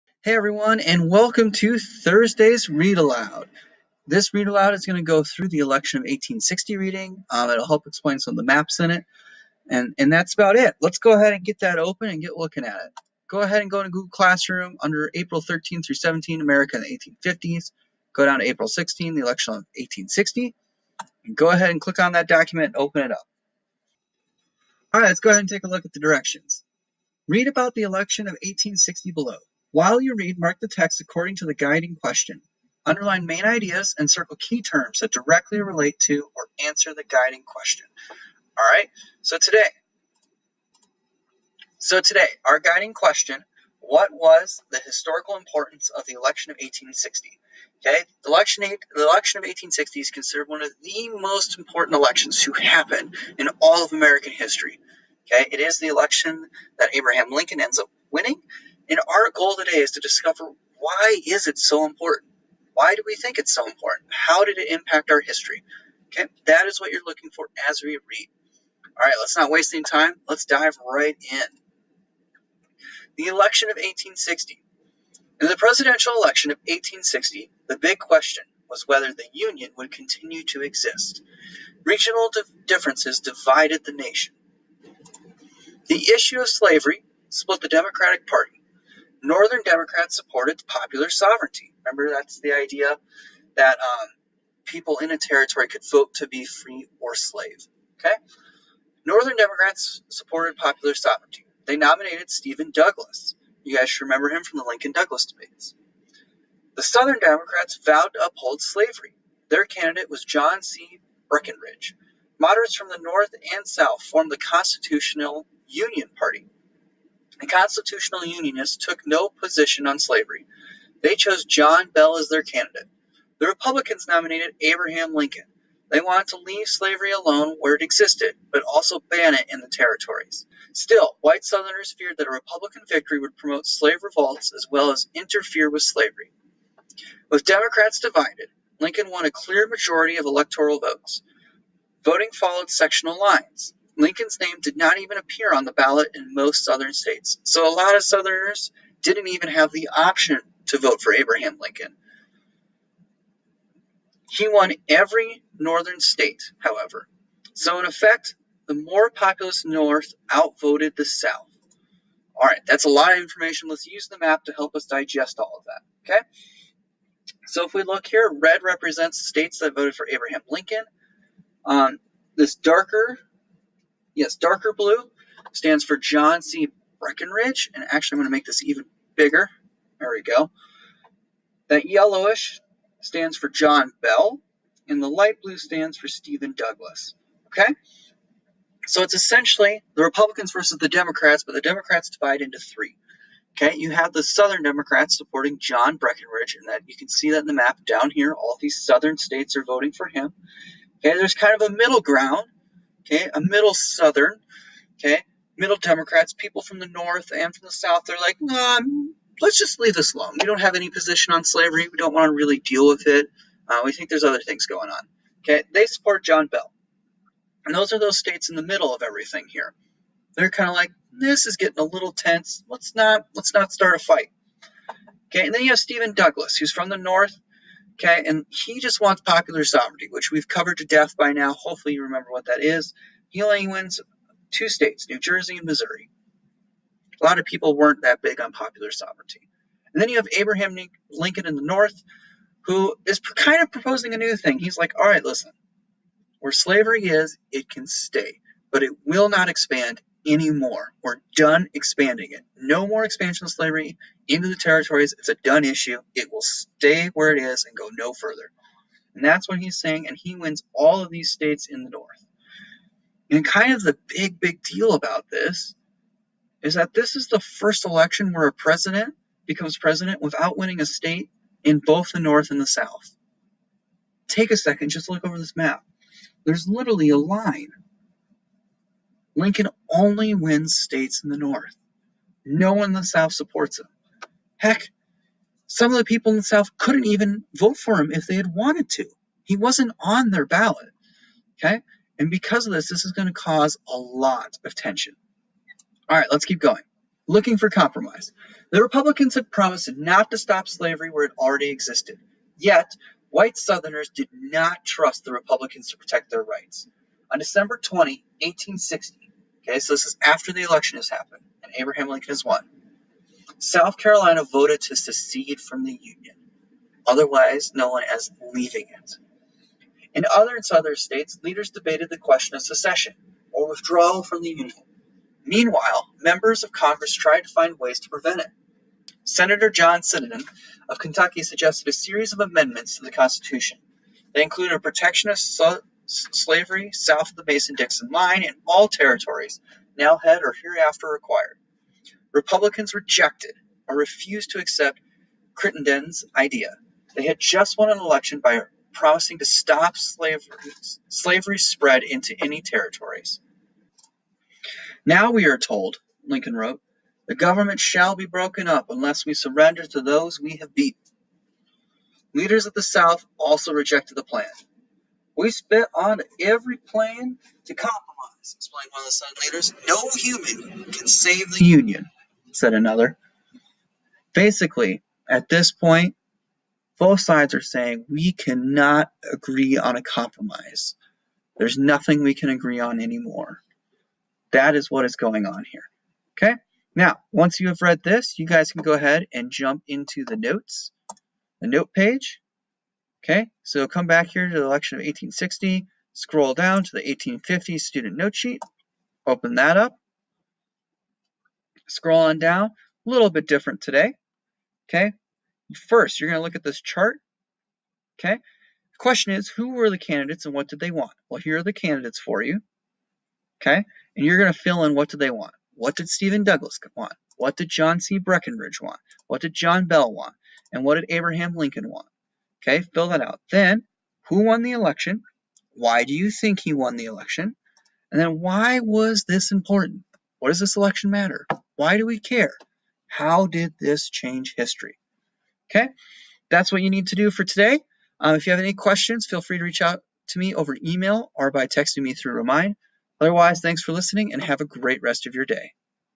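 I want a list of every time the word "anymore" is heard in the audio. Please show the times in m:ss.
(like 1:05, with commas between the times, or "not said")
4:10, 6:23.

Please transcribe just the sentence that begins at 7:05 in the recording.
Why do you think he won the election?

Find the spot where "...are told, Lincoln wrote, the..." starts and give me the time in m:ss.
5:55.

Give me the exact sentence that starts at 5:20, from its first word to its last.
In other and southern states, leaders debated the question of secession or withdrawal from the Union.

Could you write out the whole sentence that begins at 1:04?
How did it impact our history?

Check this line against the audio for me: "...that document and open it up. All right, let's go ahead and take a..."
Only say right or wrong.
right.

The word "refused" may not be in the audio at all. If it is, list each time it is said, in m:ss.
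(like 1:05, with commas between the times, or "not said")
5:43.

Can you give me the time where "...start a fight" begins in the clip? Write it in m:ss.
3:43.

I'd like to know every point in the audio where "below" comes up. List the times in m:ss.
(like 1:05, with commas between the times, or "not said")
0:29.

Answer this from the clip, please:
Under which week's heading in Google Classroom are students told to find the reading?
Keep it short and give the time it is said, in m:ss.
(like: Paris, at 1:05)
April 13 through 17, at 0:15.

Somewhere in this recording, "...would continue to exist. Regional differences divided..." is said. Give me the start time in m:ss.
1:19.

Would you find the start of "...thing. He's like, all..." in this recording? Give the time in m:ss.
4:04.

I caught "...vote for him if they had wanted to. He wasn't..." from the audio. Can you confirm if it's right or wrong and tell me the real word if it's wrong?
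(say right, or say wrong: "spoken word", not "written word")
right.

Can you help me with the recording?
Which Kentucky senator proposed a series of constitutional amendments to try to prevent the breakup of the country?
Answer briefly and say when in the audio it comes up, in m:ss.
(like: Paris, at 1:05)
John Crittenden, at 5:29.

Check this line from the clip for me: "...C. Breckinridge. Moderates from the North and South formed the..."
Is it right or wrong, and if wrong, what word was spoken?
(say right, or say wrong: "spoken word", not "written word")
right.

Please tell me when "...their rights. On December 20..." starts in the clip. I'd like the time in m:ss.
5:06.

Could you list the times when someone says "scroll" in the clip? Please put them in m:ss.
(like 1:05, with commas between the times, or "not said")
6:36, 6:41.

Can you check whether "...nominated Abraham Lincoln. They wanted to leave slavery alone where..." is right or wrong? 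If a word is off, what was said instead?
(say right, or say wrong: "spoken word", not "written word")
right.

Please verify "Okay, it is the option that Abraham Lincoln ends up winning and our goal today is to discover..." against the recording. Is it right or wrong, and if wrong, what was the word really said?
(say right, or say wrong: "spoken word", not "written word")
wrong: "election", not "option".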